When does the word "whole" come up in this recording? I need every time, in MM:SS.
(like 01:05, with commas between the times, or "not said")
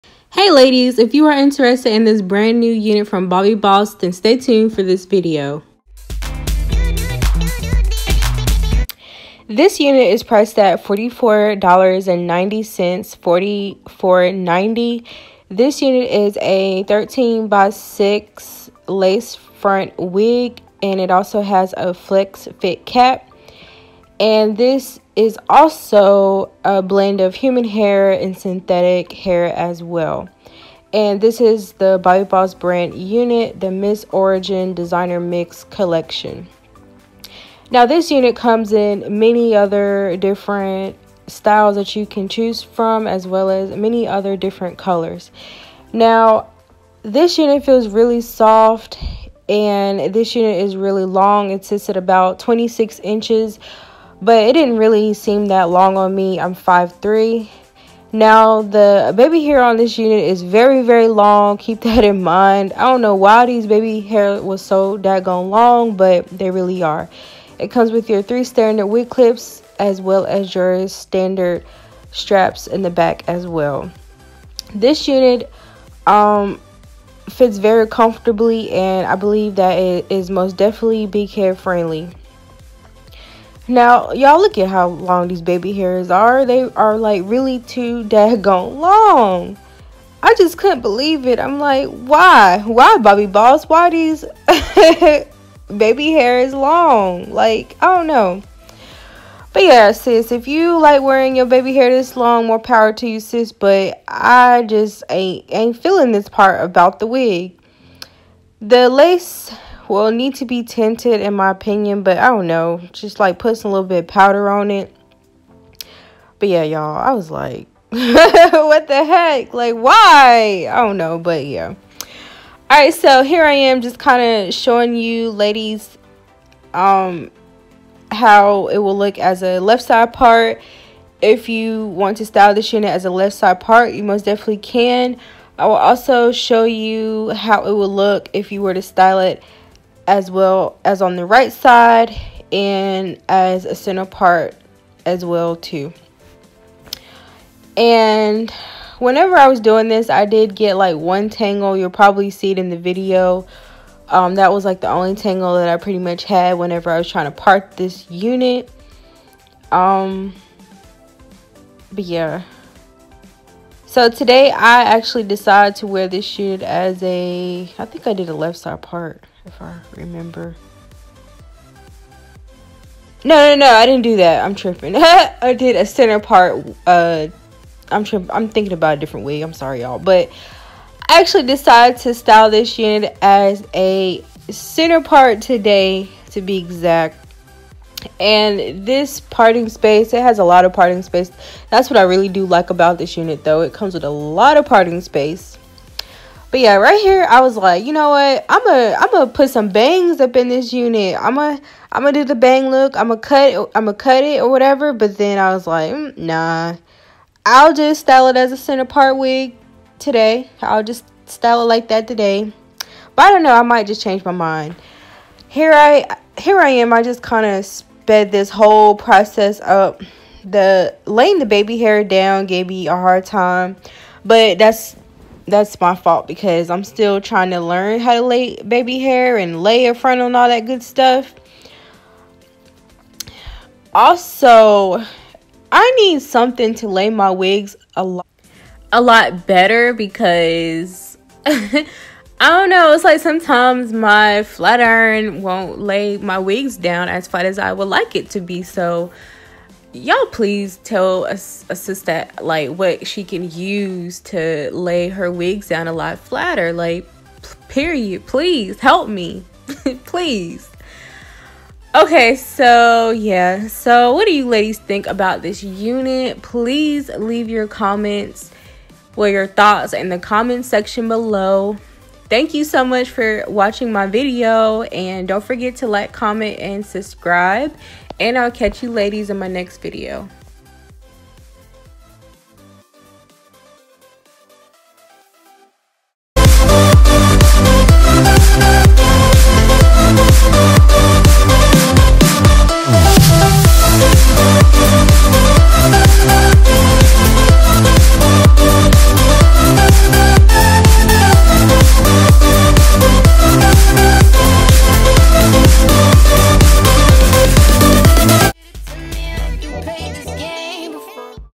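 03:38.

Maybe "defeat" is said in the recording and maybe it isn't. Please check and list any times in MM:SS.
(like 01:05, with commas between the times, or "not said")
not said.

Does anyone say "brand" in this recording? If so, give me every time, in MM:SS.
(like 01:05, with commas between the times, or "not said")
00:02, 00:32.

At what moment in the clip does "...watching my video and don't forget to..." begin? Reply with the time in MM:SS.
04:33.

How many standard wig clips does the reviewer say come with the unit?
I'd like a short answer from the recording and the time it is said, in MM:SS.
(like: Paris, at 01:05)
3, at 01:08.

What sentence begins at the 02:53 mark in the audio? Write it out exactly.
No, no, no, I didn't do that.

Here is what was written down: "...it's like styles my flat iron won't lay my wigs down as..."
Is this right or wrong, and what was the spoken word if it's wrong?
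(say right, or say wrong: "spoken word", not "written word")
wrong: "sometimes", not "styles".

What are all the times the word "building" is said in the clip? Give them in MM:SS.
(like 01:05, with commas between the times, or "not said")
not said.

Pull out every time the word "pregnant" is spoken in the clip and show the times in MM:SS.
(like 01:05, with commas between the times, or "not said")
not said.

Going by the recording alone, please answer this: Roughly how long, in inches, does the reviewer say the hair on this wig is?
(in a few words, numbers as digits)
26 inches.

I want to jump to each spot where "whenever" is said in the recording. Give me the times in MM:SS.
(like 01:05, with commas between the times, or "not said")
02:28, 02:36.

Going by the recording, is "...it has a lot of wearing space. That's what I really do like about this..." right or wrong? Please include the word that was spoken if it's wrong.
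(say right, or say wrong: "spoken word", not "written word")
wrong: "parting", not "wearing".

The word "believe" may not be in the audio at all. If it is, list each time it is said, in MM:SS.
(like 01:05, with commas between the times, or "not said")
01:19, 01:30.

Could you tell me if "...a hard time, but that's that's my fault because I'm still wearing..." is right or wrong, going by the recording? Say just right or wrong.
wrong.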